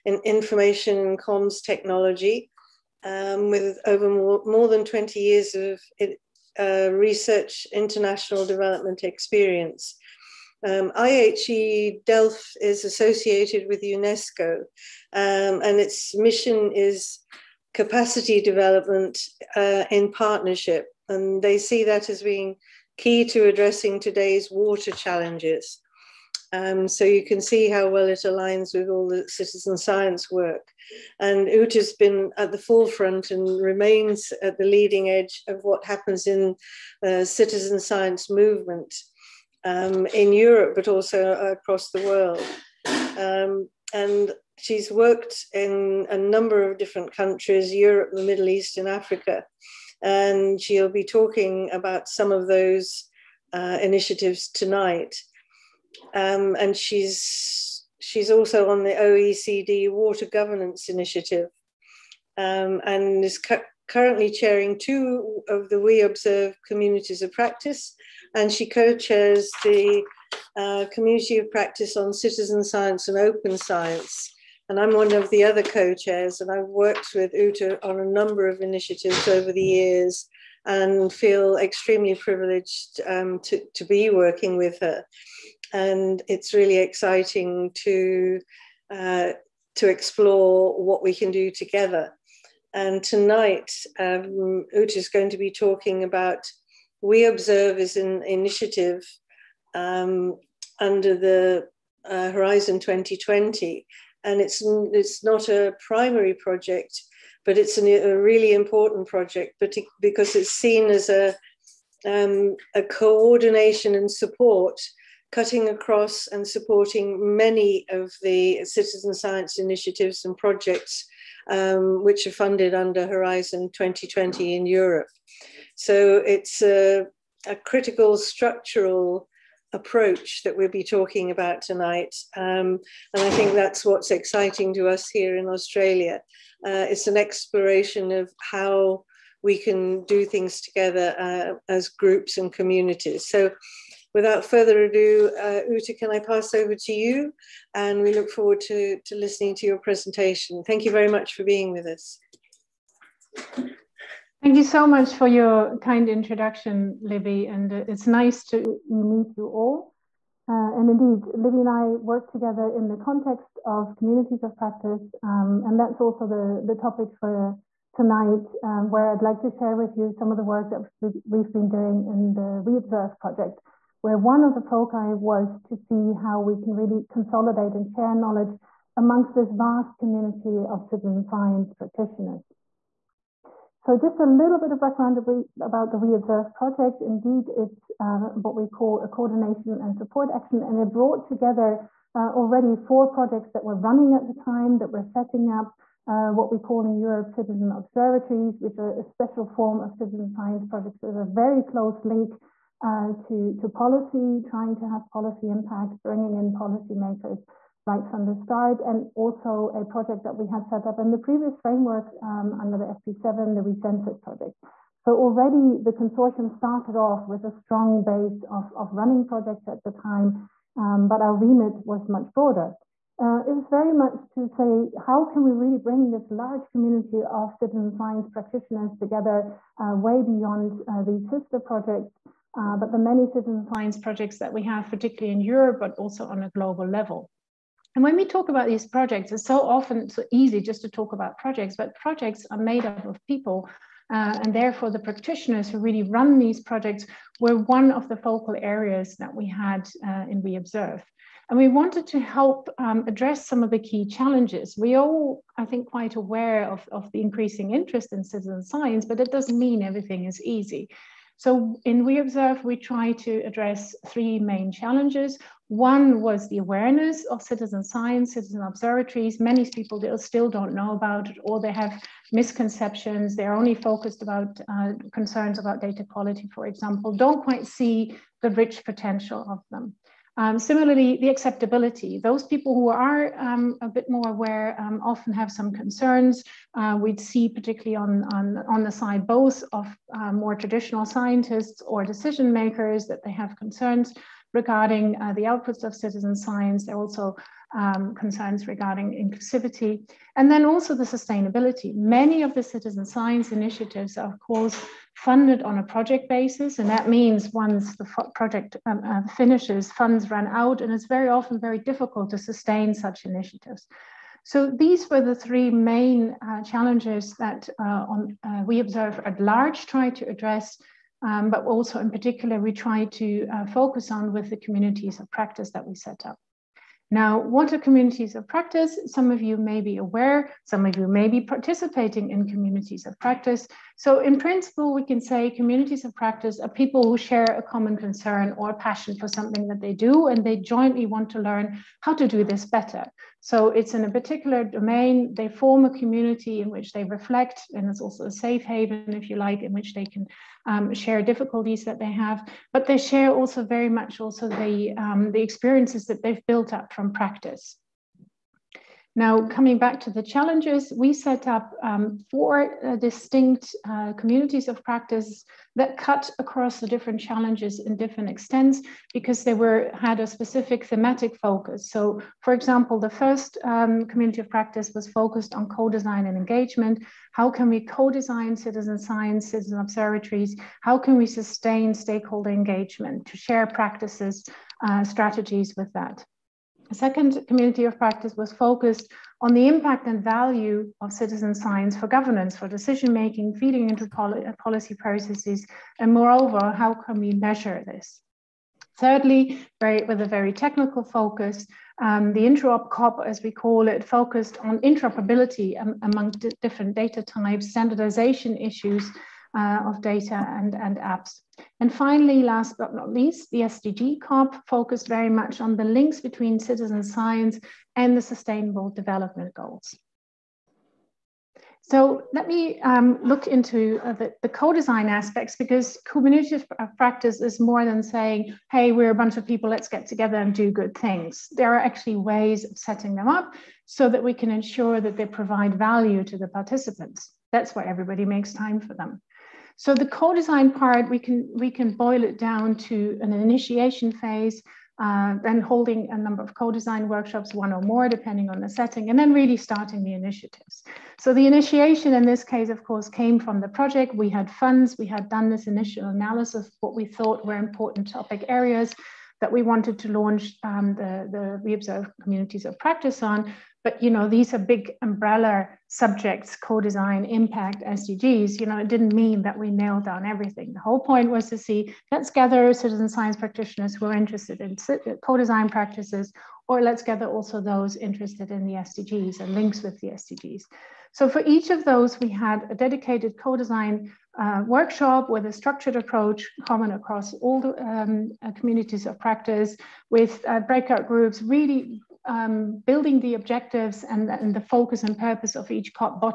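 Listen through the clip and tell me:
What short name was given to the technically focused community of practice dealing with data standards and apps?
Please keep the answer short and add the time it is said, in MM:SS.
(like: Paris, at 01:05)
interop COP, at 06:42.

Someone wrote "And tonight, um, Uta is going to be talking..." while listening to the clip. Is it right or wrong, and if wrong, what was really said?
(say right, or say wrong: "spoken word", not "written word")
right.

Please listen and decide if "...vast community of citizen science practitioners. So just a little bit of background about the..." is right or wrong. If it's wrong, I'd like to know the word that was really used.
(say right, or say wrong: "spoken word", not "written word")
right.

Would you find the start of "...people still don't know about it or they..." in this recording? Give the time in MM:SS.
04:29.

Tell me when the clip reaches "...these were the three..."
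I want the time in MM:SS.
05:14.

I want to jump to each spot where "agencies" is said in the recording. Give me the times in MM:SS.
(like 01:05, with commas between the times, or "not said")
not said.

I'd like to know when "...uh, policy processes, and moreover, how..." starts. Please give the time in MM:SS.
06:34.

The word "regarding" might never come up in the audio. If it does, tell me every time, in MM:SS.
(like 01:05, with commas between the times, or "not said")
04:54, 04:58.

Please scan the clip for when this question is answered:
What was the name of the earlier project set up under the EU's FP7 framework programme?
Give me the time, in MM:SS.
03:33.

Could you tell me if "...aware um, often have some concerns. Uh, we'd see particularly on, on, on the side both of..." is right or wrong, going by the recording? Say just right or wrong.
right.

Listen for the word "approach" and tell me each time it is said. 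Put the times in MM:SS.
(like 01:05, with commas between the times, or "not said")
02:09, 08:05.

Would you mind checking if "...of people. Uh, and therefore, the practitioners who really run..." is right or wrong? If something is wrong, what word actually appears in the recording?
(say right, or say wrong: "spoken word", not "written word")
right.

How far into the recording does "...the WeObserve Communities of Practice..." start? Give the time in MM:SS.
07:41.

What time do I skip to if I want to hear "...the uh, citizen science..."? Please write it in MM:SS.
00:37.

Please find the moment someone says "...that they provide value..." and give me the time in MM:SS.
07:15.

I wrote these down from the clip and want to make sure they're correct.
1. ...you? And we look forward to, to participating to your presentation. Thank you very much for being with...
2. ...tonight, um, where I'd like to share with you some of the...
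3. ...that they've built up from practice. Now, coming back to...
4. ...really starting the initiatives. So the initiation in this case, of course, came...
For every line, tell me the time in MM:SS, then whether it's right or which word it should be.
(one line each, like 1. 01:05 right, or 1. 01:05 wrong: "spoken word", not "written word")
1. 02:26 wrong: "listening", not "participating"
2. 02:47 right
3. 05:56 right
4. 07:29 right.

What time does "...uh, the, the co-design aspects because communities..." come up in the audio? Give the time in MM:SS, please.
07:04.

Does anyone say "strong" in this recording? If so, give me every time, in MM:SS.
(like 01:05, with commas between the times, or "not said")
03:37.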